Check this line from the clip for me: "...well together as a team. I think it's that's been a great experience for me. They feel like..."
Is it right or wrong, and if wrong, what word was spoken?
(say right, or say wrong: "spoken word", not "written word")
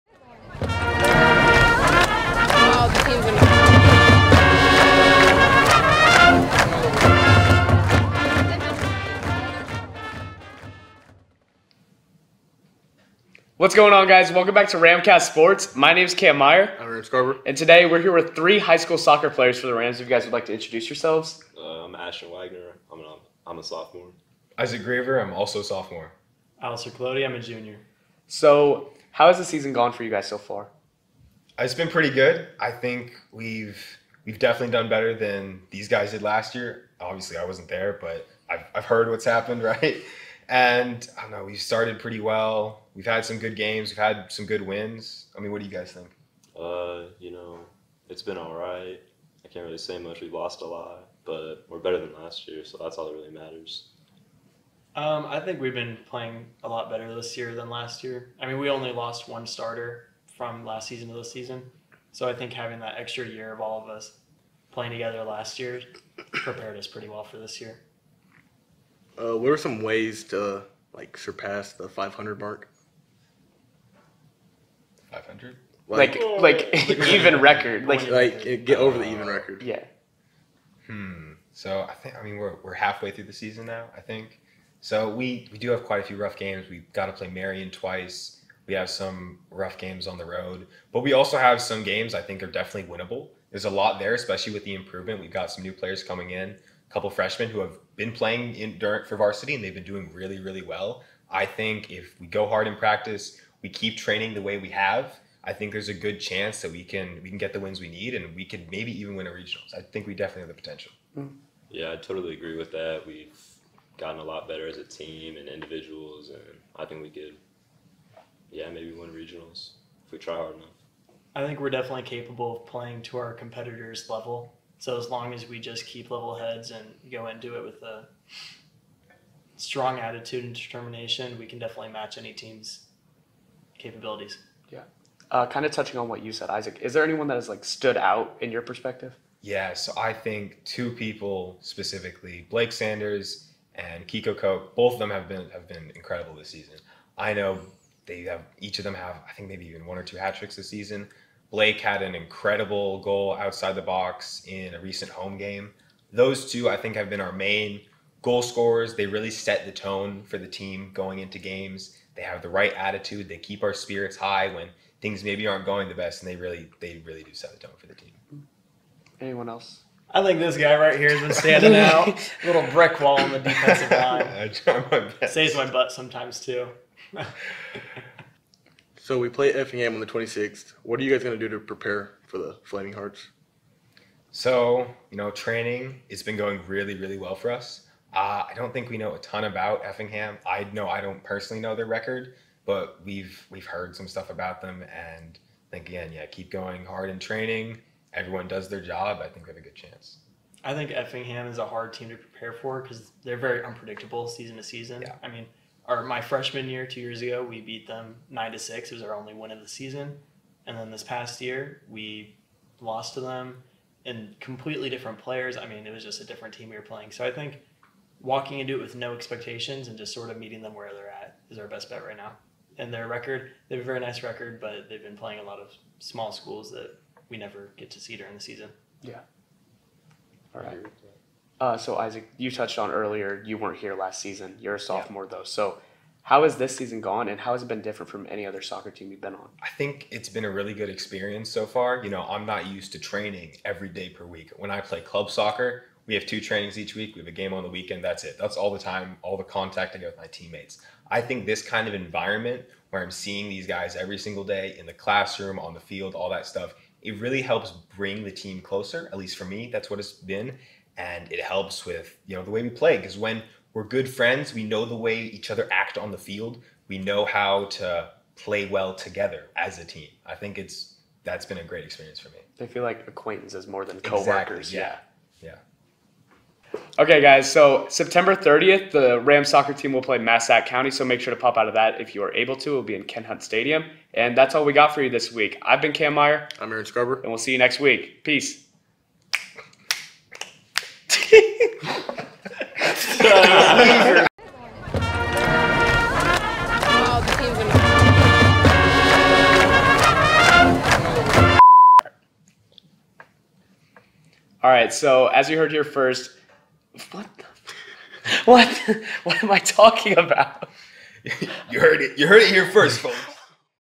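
right.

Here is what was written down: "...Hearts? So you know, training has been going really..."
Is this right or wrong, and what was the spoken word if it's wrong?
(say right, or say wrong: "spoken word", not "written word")
right.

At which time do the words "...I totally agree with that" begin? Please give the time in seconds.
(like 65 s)
111 s.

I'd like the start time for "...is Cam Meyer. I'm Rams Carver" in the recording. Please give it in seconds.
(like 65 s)
16 s.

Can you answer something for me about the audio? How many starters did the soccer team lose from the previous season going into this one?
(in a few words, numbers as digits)
1.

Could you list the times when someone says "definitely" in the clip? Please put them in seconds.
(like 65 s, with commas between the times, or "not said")
34 s, 92 s, 110 s, 121 s, 131 s.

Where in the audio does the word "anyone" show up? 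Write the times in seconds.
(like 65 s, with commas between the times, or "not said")
137 s, 169 s.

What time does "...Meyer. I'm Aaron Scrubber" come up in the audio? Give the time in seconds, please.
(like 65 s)
286 s.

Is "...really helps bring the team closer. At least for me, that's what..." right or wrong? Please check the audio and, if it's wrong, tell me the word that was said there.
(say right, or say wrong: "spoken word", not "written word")
right.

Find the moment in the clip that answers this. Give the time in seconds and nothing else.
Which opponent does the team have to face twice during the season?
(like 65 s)
87 s.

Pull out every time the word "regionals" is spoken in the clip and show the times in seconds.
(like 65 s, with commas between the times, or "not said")
109 s, 119 s.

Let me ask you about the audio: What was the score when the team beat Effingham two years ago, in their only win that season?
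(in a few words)
9 to 6.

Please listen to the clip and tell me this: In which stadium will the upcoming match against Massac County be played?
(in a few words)
Ken Hunt Stadium.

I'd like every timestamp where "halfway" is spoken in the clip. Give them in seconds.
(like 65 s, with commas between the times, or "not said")
82 s.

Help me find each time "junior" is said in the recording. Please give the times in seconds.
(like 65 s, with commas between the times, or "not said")
27 s.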